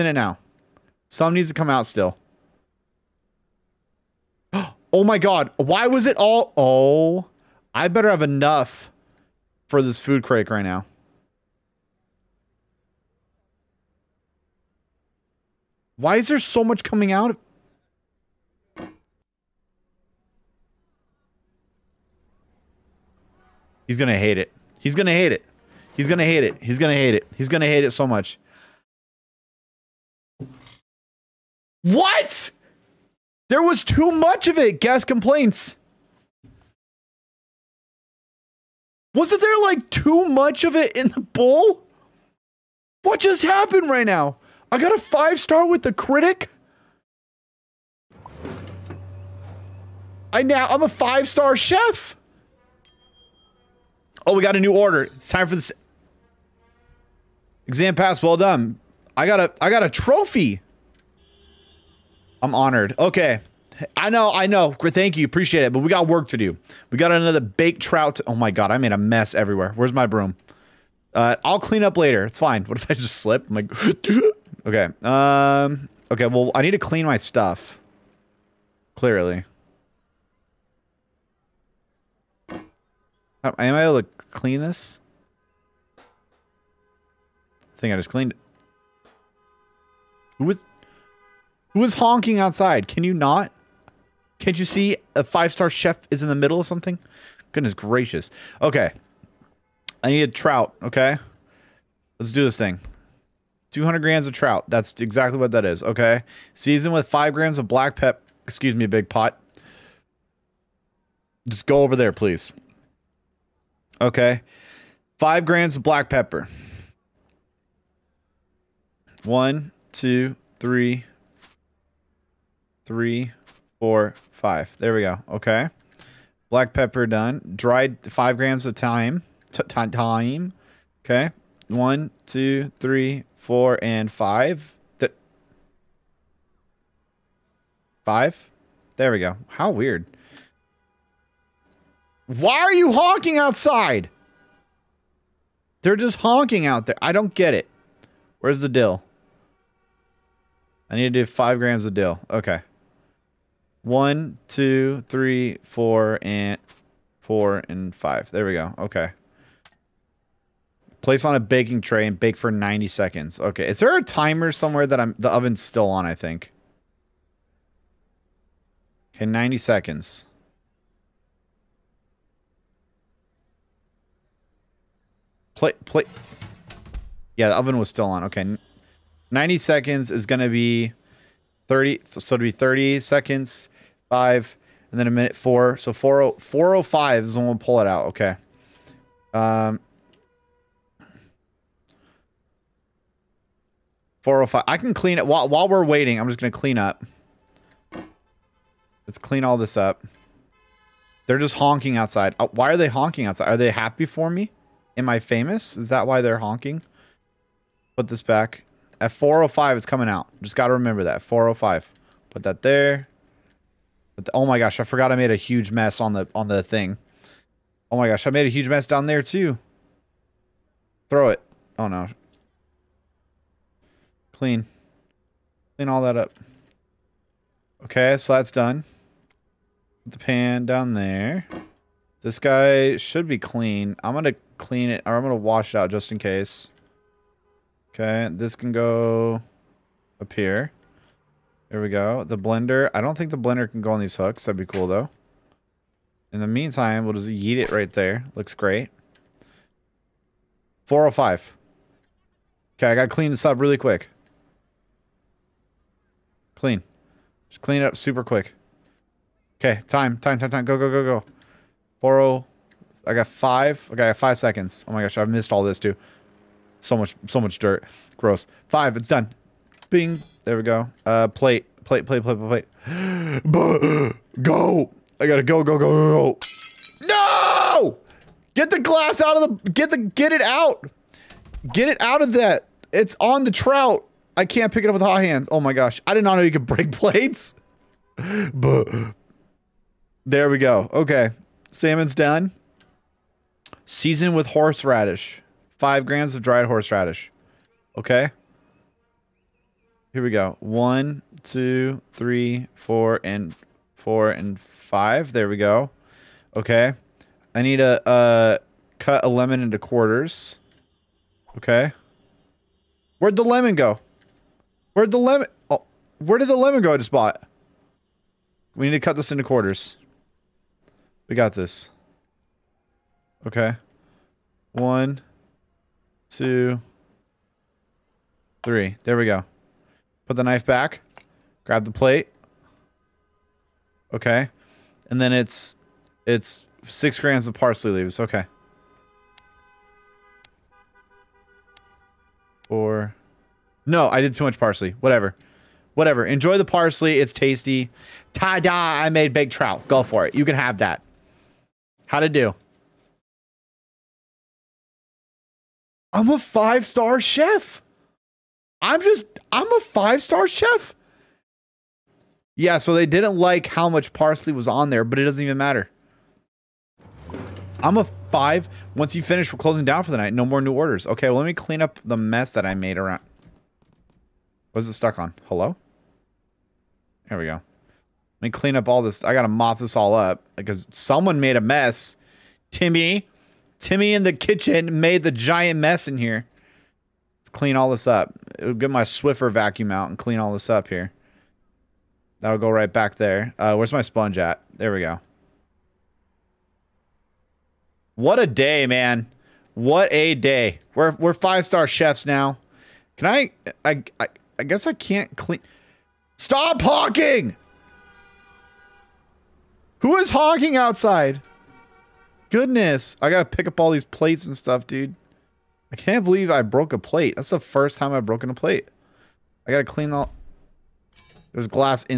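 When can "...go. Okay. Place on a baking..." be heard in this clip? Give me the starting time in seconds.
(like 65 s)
158 s.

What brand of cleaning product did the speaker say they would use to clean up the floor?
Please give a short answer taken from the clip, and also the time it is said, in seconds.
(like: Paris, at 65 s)
Swiffer, at 389 s.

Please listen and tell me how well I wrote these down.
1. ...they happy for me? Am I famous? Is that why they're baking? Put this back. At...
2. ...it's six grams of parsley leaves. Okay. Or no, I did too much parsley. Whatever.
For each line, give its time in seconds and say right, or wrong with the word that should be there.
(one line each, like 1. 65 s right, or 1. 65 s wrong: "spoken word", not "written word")
1. 203 s wrong: "honking", not "baking"
2. 336 s right.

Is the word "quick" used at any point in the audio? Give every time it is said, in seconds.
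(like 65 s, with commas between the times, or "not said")
253 s, 258 s.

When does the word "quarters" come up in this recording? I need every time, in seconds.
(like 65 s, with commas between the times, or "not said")
309 s, 319 s.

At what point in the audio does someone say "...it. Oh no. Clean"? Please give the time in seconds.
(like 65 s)
221 s.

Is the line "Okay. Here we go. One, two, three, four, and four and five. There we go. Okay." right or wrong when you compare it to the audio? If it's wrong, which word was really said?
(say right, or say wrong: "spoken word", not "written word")
right.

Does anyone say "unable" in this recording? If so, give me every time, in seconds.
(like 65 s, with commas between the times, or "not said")
not said.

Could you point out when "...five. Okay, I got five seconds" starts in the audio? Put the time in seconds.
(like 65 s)
263 s.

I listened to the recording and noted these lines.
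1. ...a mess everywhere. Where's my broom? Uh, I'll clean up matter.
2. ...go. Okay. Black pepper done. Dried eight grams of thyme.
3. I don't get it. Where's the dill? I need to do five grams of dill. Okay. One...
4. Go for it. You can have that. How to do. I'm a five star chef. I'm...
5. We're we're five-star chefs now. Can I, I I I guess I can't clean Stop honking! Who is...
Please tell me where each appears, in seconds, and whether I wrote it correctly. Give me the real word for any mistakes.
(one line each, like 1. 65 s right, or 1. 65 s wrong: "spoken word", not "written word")
1. 68 s wrong: "later", not "matter"
2. 125 s wrong: "five", not "eight"
3. 147 s right
4. 349 s right
5. 400 s right.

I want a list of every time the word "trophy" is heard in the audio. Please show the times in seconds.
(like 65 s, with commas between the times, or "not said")
59 s.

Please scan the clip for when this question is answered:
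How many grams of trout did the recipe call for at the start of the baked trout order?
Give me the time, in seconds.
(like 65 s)
103 s.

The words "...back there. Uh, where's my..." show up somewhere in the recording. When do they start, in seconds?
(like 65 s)
392 s.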